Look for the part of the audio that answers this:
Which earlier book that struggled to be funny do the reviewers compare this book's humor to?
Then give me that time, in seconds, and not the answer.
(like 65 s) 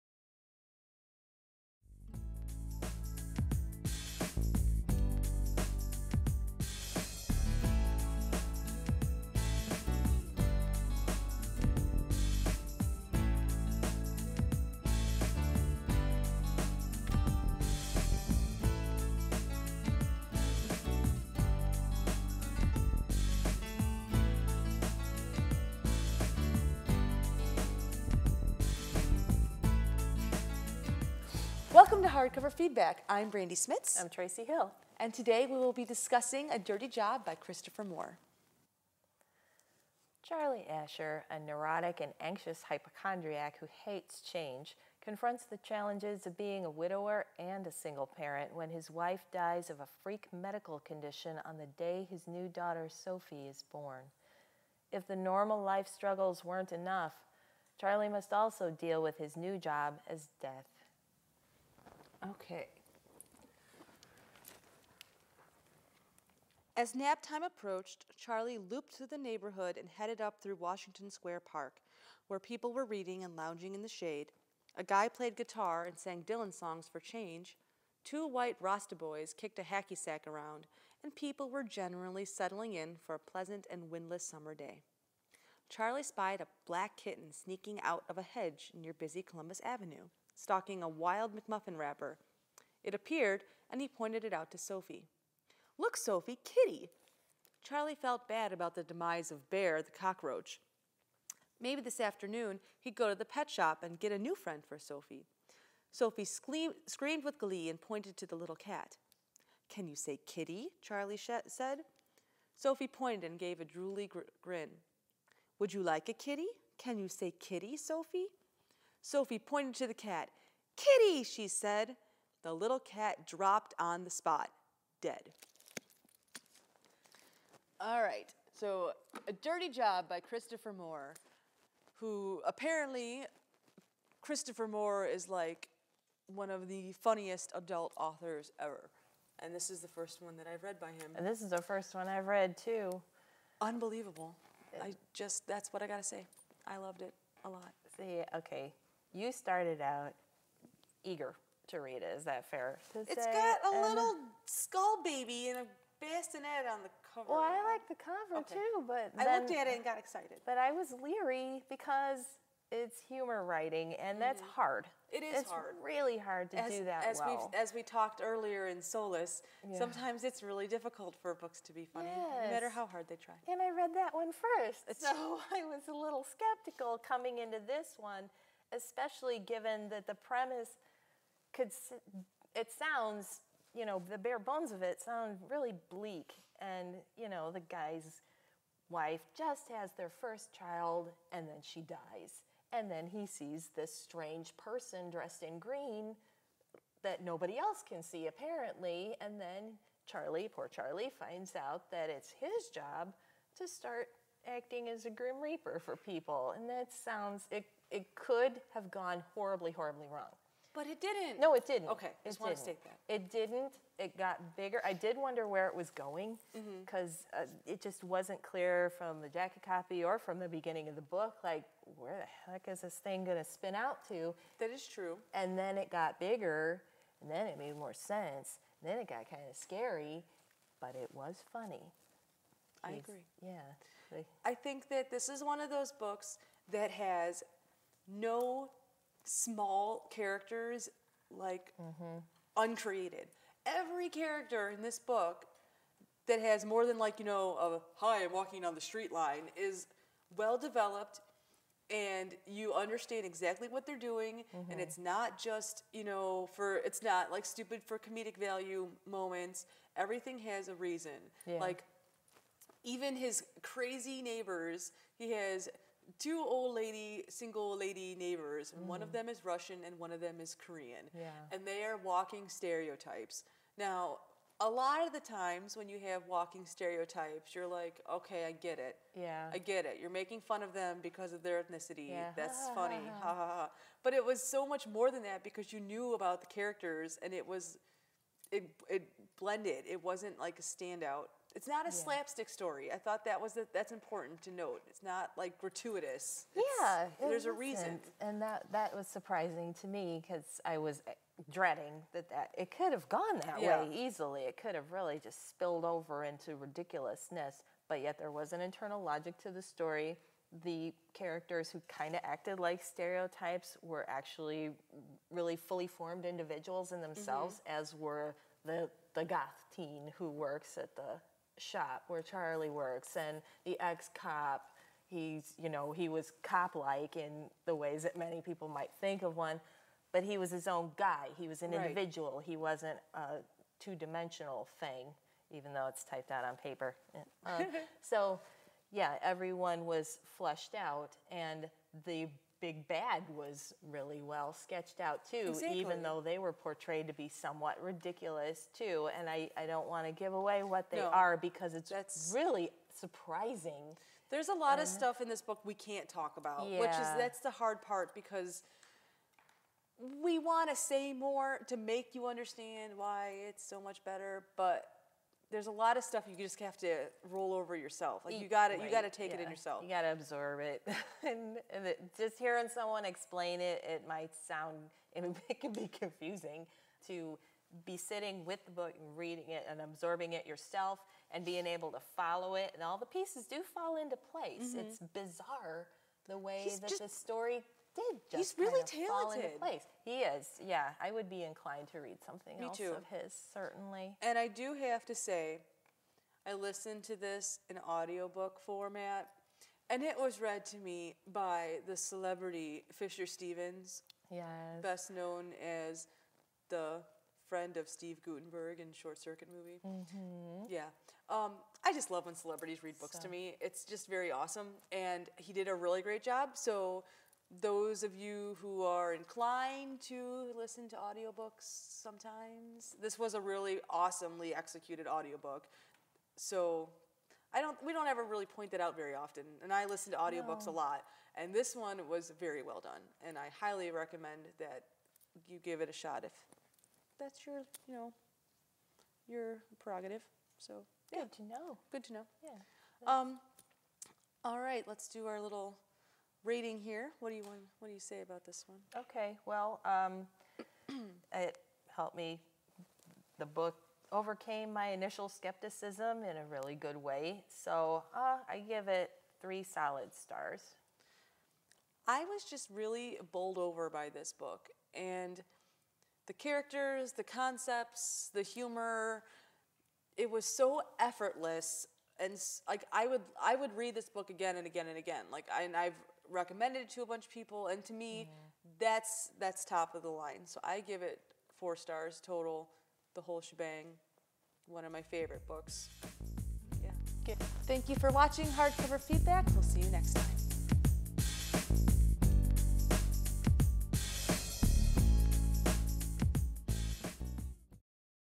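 168 s.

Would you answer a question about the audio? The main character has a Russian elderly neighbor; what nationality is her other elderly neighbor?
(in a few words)
Korean.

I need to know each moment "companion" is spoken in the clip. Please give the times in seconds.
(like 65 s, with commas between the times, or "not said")
not said.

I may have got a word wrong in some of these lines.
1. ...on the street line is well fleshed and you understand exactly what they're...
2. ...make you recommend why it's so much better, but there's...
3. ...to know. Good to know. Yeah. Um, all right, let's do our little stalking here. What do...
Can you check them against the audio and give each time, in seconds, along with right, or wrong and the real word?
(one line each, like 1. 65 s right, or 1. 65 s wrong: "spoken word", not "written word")
1. 248 s wrong: "developed", not "fleshed"
2. 361 s wrong: "understand", not "recommend"
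3. 441 s wrong: "rating", not "stalking".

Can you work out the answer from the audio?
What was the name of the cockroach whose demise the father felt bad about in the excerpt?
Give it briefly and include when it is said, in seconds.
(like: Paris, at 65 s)
Bear, at 99 s.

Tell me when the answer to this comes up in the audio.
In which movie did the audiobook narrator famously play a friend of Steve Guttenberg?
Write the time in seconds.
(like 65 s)
408 s.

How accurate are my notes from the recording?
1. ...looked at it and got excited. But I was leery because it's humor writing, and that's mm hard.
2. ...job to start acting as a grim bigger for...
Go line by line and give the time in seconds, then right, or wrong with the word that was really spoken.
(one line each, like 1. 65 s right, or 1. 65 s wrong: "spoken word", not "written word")
1. 159 s right
2. 202 s wrong: "reaper", not "bigger".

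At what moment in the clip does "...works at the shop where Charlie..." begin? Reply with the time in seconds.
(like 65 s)
320 s.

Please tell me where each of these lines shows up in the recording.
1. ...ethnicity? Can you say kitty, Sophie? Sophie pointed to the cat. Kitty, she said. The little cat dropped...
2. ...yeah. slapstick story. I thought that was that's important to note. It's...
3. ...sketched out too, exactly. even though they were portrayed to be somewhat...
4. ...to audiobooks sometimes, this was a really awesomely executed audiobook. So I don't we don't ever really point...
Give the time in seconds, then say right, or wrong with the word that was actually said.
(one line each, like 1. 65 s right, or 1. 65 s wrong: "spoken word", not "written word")
1. 116 s wrong: "kitty", not "ethnicity"
2. 291 s right
3. 344 s right
4. 420 s right.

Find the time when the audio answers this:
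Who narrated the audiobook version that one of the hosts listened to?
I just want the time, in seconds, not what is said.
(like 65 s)
402 s.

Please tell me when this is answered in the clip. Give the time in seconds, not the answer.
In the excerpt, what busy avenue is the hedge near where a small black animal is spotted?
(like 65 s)
89 s.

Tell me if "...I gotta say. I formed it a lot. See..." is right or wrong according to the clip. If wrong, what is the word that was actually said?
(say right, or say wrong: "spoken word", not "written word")
wrong: "loved", not "formed".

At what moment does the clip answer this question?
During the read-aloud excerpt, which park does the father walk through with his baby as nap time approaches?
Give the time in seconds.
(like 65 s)
70 s.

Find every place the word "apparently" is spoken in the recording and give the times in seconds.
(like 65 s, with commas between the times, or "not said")
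132 s, 198 s.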